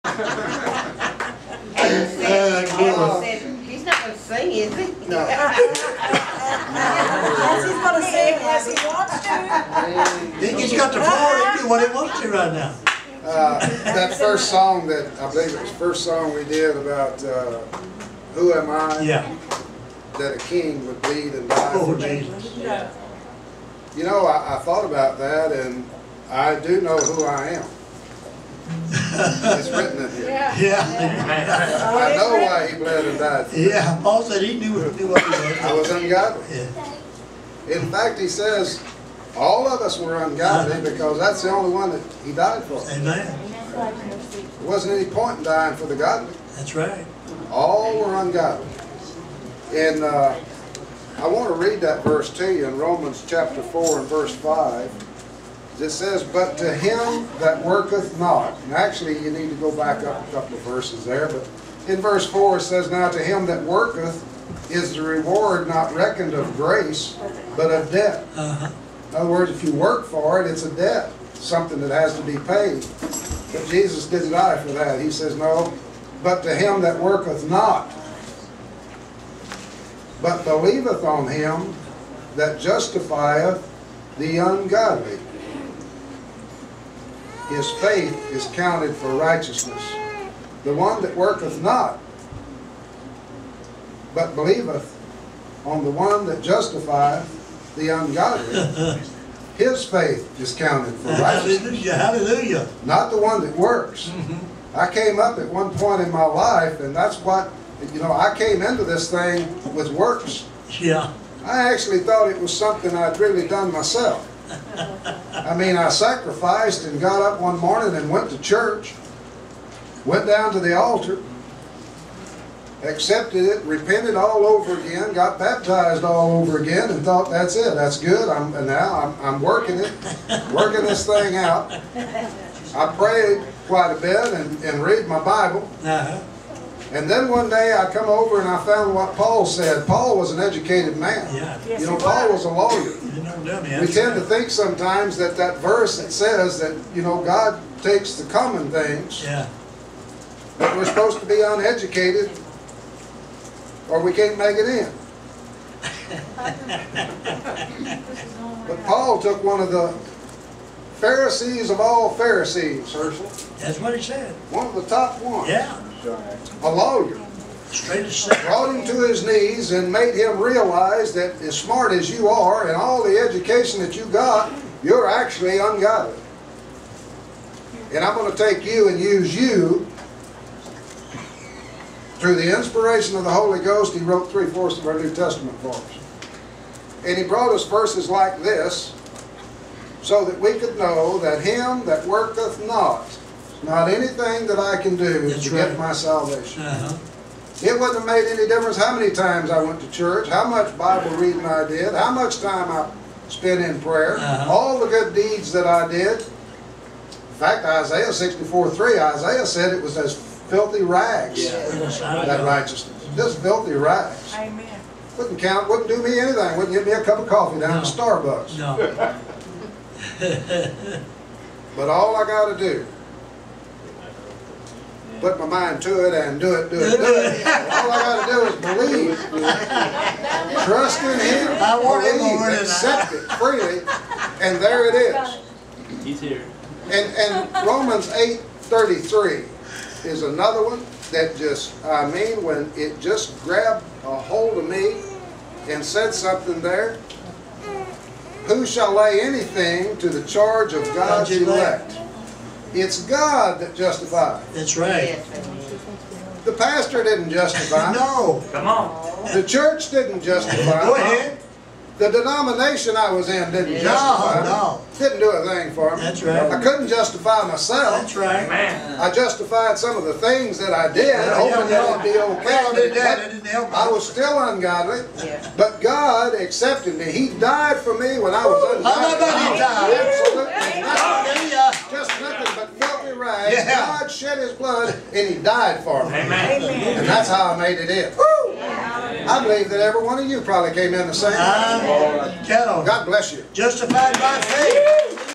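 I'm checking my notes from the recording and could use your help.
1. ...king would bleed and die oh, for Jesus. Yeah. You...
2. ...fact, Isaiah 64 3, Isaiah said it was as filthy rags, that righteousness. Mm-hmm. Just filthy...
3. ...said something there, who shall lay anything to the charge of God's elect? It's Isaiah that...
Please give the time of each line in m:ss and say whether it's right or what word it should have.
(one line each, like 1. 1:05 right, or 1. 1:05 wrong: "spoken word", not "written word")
1. 0:20 right
2. 3:27 right
3. 4:05 wrong: "God", not "Isaiah".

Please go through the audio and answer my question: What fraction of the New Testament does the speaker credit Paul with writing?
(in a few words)
Three-fourths.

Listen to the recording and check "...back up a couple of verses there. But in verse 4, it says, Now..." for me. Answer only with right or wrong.
right.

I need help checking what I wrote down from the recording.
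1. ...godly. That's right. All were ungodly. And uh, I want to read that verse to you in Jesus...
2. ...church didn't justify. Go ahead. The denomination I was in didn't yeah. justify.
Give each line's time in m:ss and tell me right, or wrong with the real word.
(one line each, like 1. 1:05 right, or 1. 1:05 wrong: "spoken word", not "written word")
1. 0:45 wrong: "Romans", not "Jesus"
2. 4:19 right.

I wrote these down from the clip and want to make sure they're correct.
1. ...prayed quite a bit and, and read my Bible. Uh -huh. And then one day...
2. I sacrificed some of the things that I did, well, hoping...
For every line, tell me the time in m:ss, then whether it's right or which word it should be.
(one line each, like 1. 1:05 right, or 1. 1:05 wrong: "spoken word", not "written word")
1. 2:12 right
2. 4:28 wrong: "justified", not "sacrificed".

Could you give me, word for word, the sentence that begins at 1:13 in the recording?
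But Jesus didn't die for that.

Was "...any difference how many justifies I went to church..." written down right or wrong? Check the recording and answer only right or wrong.
wrong.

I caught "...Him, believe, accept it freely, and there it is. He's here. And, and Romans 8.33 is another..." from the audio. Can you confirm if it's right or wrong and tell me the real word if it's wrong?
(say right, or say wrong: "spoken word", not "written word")
right.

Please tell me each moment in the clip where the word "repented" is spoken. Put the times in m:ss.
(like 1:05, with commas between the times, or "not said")
2:03.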